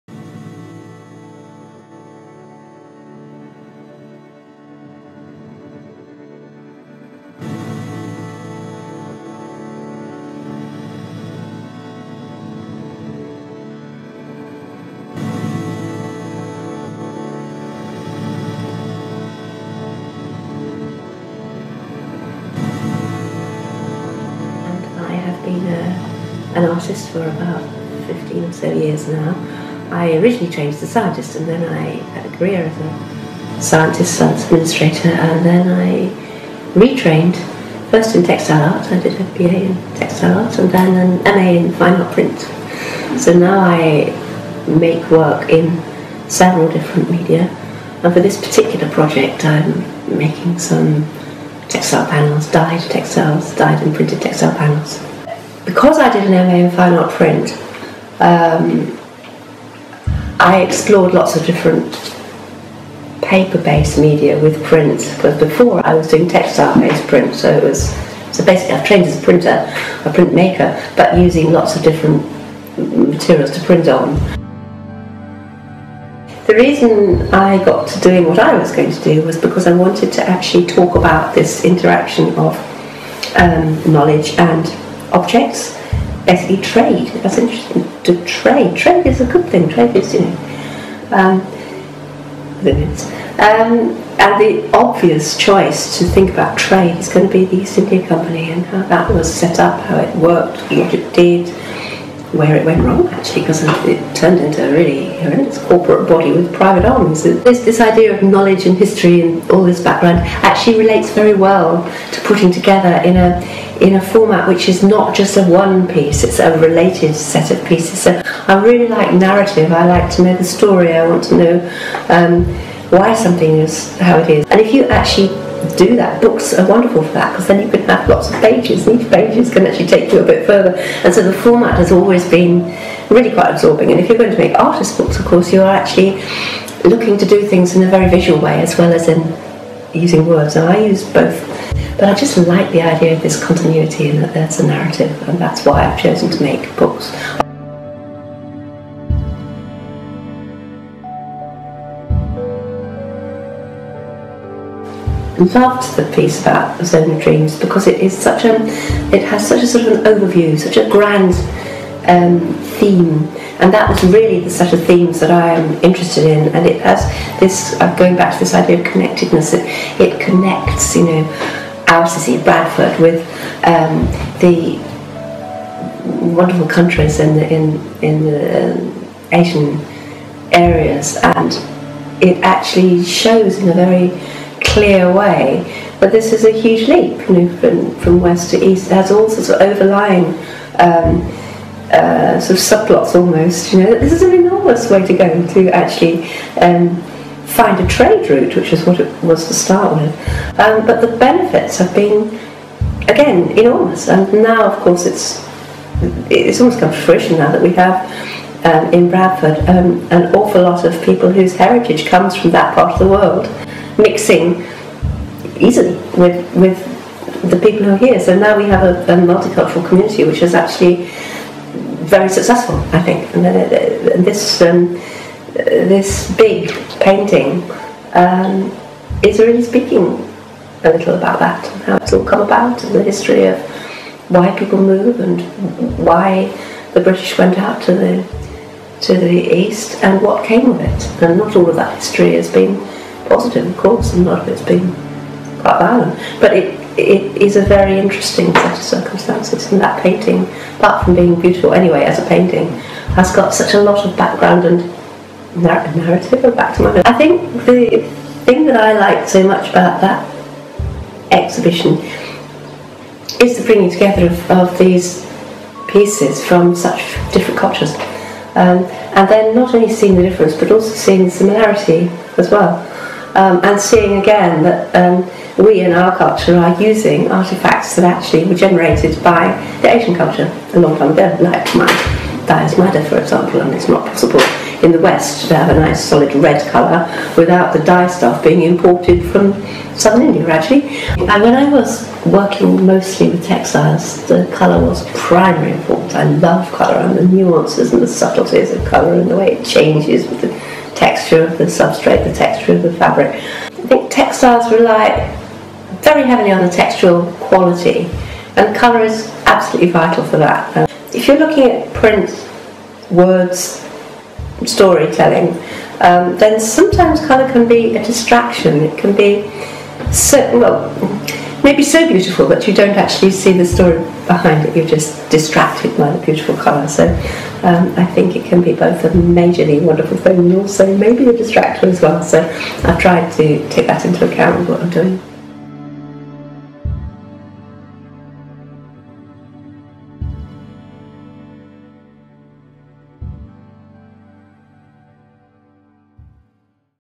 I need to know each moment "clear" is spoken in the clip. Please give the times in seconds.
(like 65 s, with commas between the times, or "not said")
184 s.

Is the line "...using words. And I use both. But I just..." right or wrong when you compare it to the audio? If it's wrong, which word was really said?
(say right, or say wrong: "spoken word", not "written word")
right.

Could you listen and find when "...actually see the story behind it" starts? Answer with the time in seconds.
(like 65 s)
322 s.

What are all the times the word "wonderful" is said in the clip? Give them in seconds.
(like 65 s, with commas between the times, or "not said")
126 s, 176 s, 329 s.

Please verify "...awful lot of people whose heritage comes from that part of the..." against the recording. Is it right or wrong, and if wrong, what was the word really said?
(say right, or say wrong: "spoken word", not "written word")
right.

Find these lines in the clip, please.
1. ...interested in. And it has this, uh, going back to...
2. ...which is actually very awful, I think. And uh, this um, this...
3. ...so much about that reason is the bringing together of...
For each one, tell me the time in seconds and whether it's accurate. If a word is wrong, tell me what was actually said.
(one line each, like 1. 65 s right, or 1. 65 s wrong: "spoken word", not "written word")
1. 165 s right
2. 220 s wrong: "successful", not "awful"
3. 259 s wrong: "exhibition", not "reason".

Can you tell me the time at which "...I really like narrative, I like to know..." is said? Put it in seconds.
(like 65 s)
118 s.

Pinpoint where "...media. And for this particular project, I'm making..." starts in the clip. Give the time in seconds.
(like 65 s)
47 s.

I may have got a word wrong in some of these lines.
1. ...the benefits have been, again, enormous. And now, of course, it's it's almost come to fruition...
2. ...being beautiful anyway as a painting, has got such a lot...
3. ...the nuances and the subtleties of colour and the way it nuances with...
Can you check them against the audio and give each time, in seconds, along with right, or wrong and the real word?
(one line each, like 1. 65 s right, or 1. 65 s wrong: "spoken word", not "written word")
1. 201 s right
2. 251 s right
3. 297 s wrong: "changes", not "nuances".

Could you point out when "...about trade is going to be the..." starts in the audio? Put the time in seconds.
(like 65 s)
96 s.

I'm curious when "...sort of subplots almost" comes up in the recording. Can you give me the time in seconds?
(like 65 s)
192 s.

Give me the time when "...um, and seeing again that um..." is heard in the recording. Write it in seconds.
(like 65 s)
273 s.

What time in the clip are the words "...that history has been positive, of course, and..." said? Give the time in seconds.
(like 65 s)
241 s.